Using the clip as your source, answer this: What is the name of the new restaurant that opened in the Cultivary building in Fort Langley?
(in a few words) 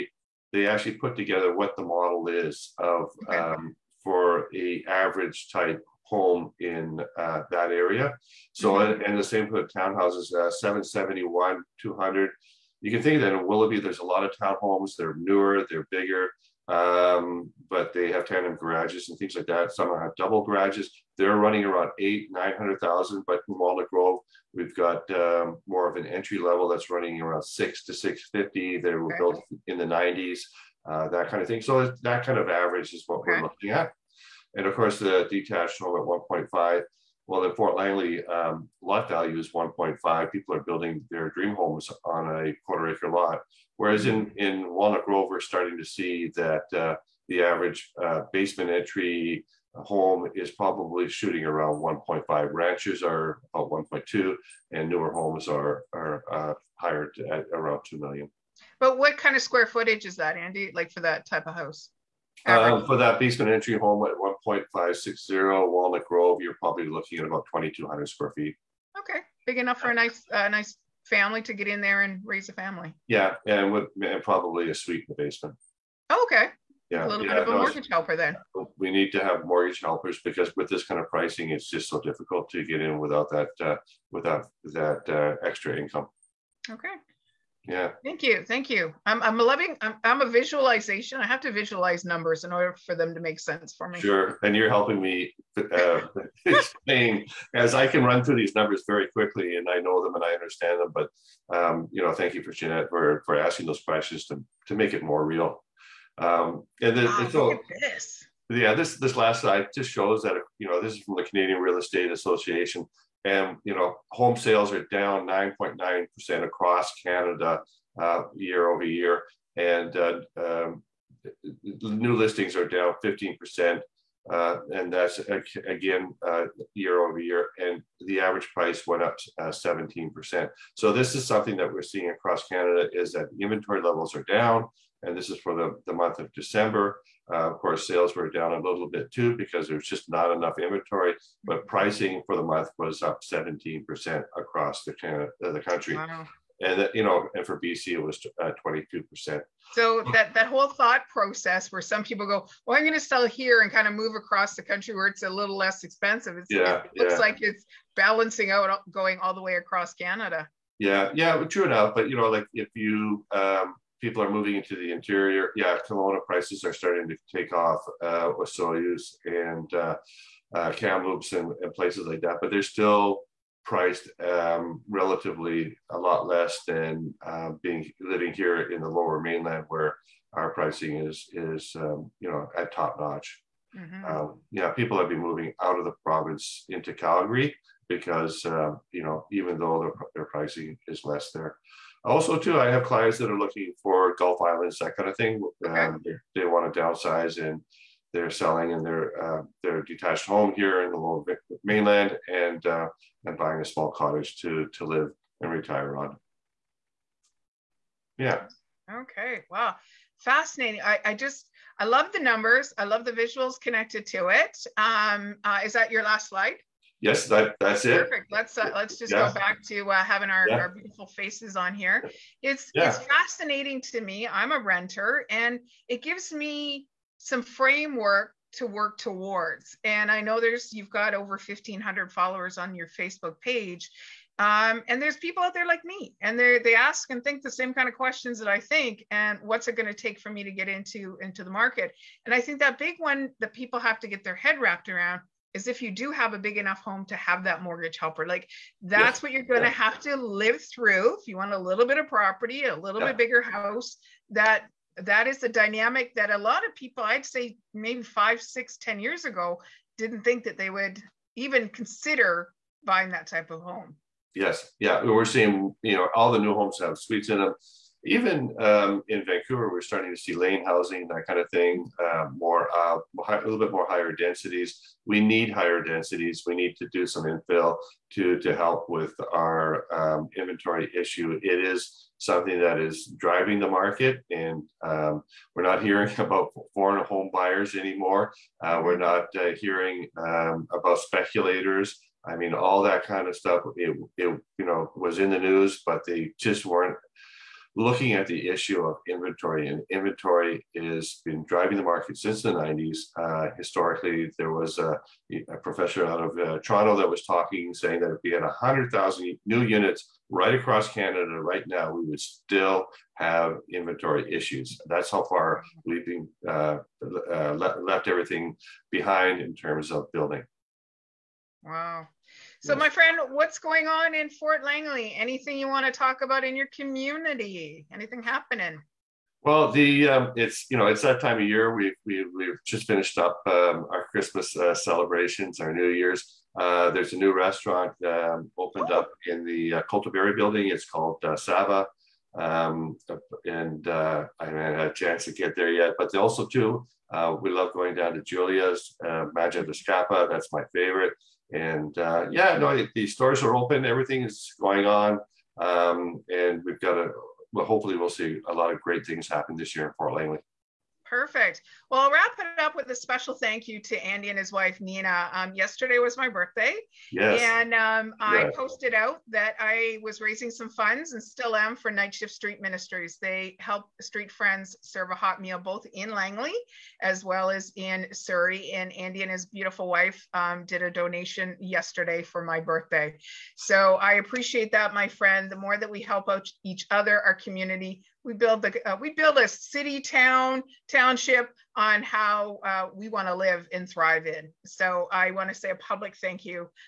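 Sava.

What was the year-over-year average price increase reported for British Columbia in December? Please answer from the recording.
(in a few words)
22%.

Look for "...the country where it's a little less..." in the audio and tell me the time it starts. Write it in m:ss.
2:34.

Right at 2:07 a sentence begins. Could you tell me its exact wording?
And the average price went up 17%.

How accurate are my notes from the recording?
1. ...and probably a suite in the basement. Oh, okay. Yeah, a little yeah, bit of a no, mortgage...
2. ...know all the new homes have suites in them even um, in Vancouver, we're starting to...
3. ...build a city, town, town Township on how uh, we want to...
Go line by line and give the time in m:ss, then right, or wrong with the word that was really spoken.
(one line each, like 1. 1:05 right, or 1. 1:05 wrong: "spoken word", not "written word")
1. 1:14 right
2. 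4:25 right
3. 6:29 right.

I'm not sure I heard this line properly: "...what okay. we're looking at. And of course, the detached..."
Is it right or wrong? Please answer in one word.
right.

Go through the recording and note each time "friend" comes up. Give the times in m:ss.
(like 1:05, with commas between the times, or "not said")
5:22, 6:14, 6:25.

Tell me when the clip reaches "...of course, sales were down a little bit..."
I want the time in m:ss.
2:17.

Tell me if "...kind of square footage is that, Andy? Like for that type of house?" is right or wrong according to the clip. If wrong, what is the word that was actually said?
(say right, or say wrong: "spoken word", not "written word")
right.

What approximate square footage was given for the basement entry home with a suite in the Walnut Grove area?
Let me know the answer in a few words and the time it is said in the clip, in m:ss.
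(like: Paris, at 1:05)
2,200 square feet, at 1:07.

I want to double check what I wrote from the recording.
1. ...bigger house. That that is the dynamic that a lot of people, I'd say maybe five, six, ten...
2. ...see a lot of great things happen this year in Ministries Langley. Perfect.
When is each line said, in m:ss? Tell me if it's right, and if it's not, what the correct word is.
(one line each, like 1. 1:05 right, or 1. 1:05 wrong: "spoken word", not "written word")
1. 4:13 right
2. 5:58 wrong: "Fort", not "Ministries".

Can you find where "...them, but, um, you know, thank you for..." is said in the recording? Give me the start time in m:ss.
1:40.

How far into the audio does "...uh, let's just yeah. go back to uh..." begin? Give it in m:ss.
3:38.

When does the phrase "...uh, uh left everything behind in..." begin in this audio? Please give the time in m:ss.
5:16.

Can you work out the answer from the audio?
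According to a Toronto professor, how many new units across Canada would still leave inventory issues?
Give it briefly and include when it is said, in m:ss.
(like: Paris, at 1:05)
100,000, at 5:08.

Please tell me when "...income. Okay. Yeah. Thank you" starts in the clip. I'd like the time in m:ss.
1:25.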